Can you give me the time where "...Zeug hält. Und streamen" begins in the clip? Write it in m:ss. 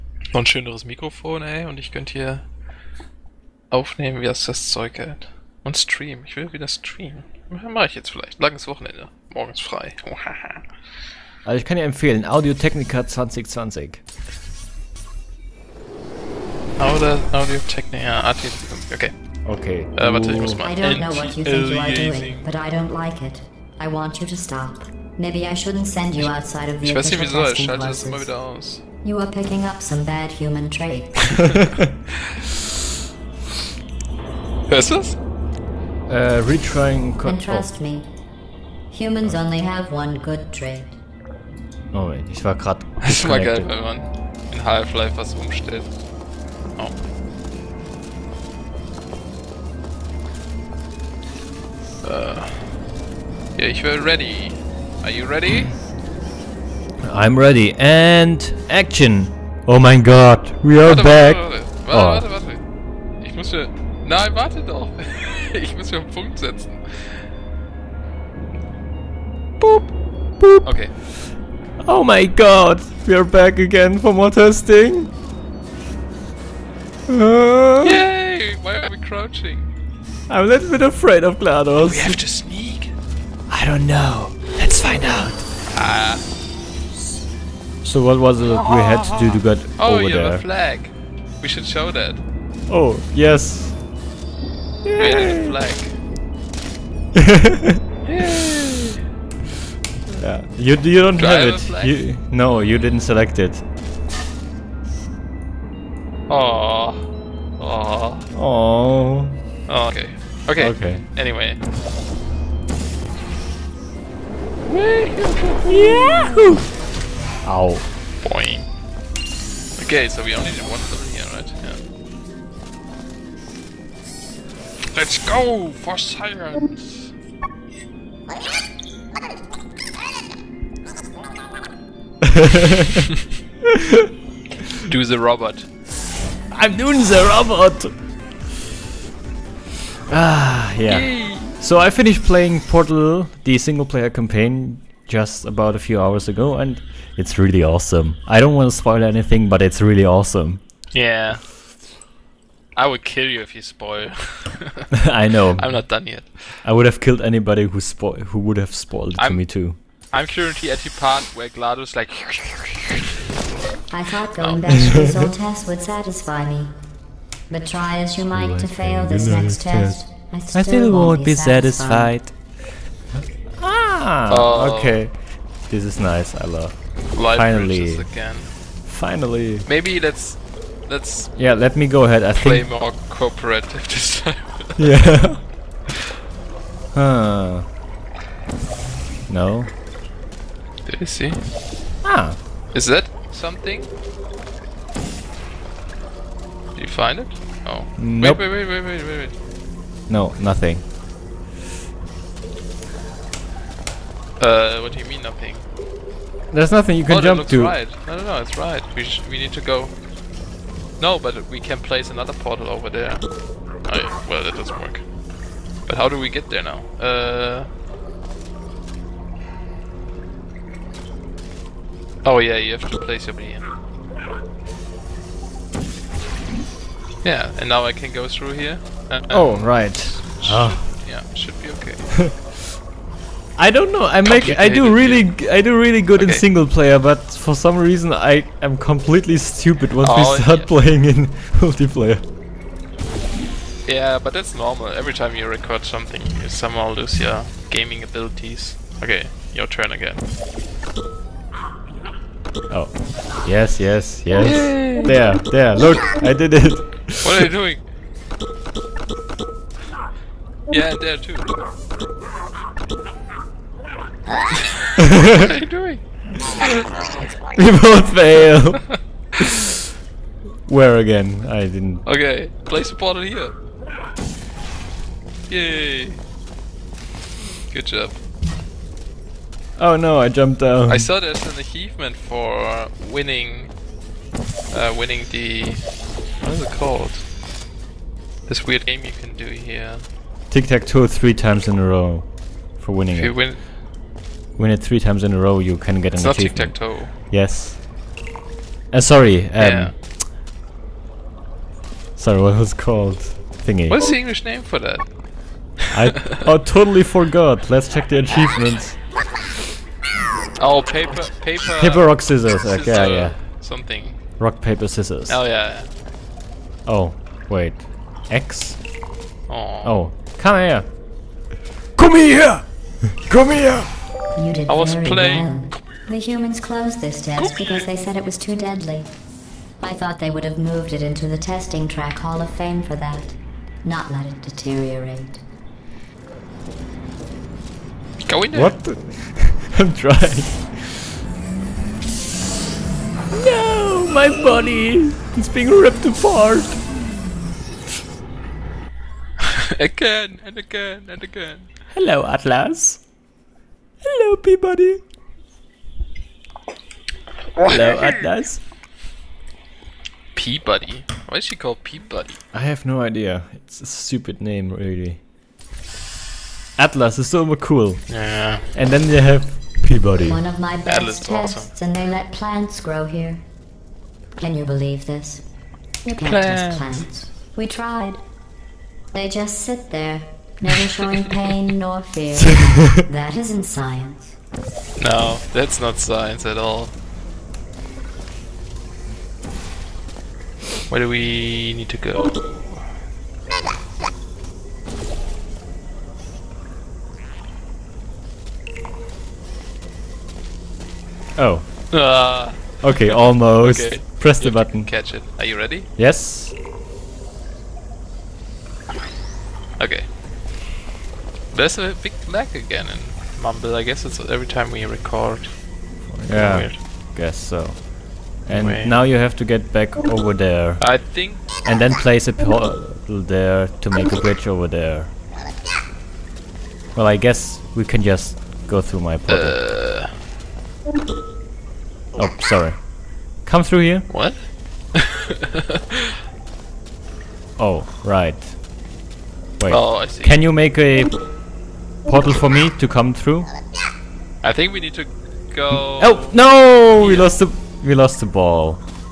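0:04.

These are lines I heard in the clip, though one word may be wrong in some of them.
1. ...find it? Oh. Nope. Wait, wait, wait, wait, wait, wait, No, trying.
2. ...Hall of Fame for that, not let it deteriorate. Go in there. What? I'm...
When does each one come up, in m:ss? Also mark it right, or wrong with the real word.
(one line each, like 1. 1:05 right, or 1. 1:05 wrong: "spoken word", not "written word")
1. 3:16 wrong: "nothing", not "trying"
2. 5:32 right.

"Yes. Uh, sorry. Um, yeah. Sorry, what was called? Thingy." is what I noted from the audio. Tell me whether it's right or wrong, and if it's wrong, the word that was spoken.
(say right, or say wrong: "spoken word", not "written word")
right.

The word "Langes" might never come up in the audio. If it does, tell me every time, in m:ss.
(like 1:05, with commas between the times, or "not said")
0:08.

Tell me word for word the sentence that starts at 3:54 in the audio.
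I make I do really I do really good okay.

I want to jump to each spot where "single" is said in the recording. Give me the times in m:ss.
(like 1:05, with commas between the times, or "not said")
2:23, 3:56.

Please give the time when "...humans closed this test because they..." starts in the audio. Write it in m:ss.
5:26.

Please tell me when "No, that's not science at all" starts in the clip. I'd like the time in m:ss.
6:25.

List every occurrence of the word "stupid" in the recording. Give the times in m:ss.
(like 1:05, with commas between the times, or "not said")
3:59, 6:03.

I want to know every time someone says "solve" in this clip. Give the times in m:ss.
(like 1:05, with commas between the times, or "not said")
not said.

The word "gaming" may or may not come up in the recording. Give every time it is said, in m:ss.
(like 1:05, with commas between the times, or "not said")
4:07.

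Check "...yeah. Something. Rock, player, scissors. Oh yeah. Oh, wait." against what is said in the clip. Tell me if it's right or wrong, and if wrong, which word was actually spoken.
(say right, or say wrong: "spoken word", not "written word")
wrong: "paper", not "player".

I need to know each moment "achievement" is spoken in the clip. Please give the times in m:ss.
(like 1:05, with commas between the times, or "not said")
4:41, 4:56, 5:08.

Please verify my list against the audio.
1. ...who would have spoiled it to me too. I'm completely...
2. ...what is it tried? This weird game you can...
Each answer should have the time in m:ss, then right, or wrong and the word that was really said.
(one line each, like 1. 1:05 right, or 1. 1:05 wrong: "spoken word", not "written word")
1. 2:38 wrong: "currently", not "completely"
2. 4:46 wrong: "called", not "tried".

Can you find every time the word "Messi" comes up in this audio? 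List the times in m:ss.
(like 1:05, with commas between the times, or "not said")
not said.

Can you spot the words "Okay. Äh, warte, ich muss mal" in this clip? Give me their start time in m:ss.
0:19.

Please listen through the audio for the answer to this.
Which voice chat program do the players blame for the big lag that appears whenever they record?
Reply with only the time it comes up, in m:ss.
6:53.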